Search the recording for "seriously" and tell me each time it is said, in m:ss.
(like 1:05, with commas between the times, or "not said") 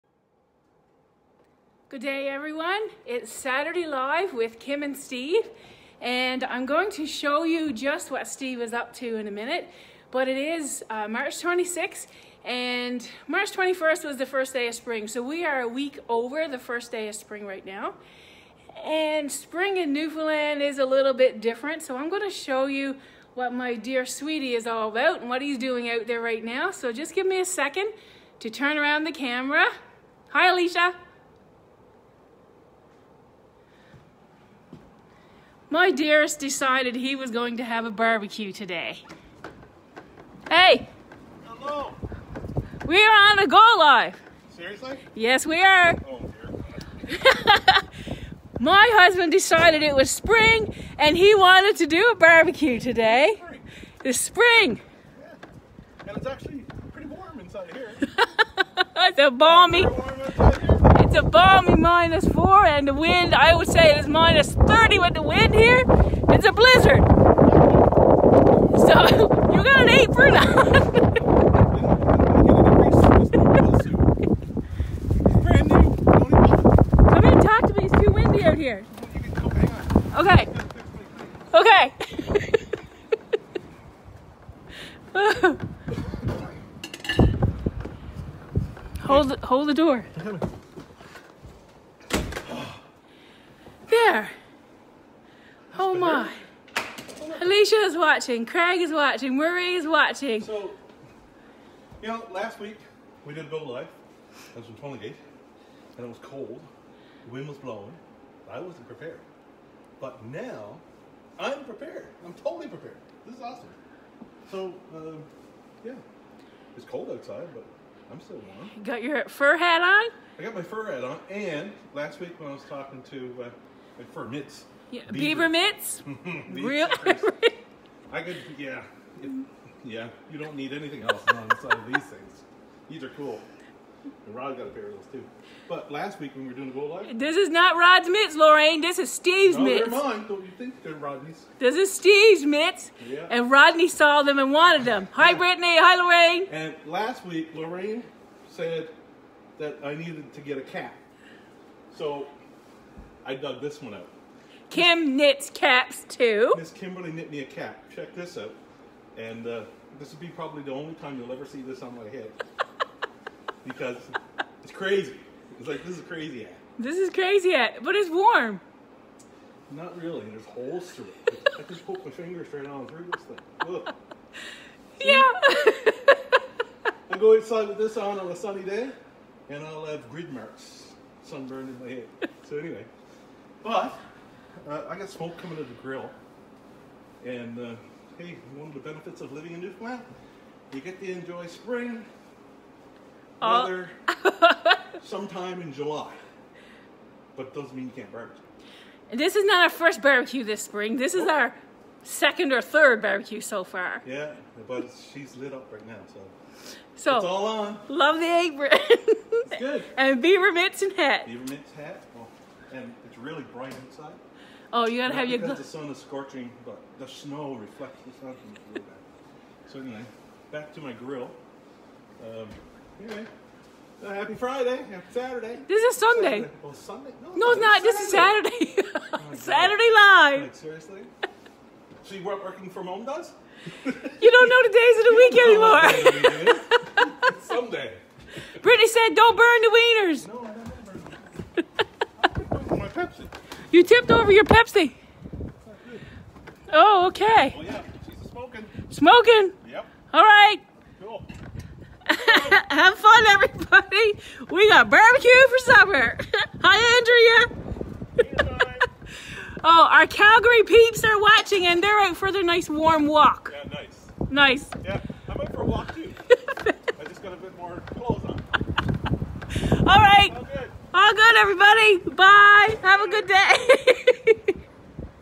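0:44, 3:50.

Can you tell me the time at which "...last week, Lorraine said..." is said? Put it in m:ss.
2:26.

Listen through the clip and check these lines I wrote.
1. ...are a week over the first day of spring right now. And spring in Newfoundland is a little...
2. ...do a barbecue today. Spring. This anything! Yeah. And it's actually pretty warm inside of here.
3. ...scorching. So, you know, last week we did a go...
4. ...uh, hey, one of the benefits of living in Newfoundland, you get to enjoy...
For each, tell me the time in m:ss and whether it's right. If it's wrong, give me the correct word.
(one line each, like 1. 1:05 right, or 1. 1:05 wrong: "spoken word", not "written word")
1. 0:15 right
2. 0:51 wrong: "spring", not "anything"
3. 1:39 wrong: "watching", not "scorching"
4. 3:07 right.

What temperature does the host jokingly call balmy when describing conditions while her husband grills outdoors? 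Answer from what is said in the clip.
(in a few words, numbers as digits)
-4.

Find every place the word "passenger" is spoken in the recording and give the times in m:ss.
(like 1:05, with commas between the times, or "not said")
not said.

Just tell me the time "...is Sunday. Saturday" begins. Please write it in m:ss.
3:45.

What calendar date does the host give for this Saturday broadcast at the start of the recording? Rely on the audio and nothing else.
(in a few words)
March 26.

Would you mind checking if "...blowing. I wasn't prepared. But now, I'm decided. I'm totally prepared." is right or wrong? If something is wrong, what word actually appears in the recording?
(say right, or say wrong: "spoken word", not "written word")
wrong: "prepared", not "decided".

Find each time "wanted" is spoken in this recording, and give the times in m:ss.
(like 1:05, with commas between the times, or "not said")
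0:51, 2:24.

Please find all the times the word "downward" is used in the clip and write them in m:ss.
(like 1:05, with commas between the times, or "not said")
not said.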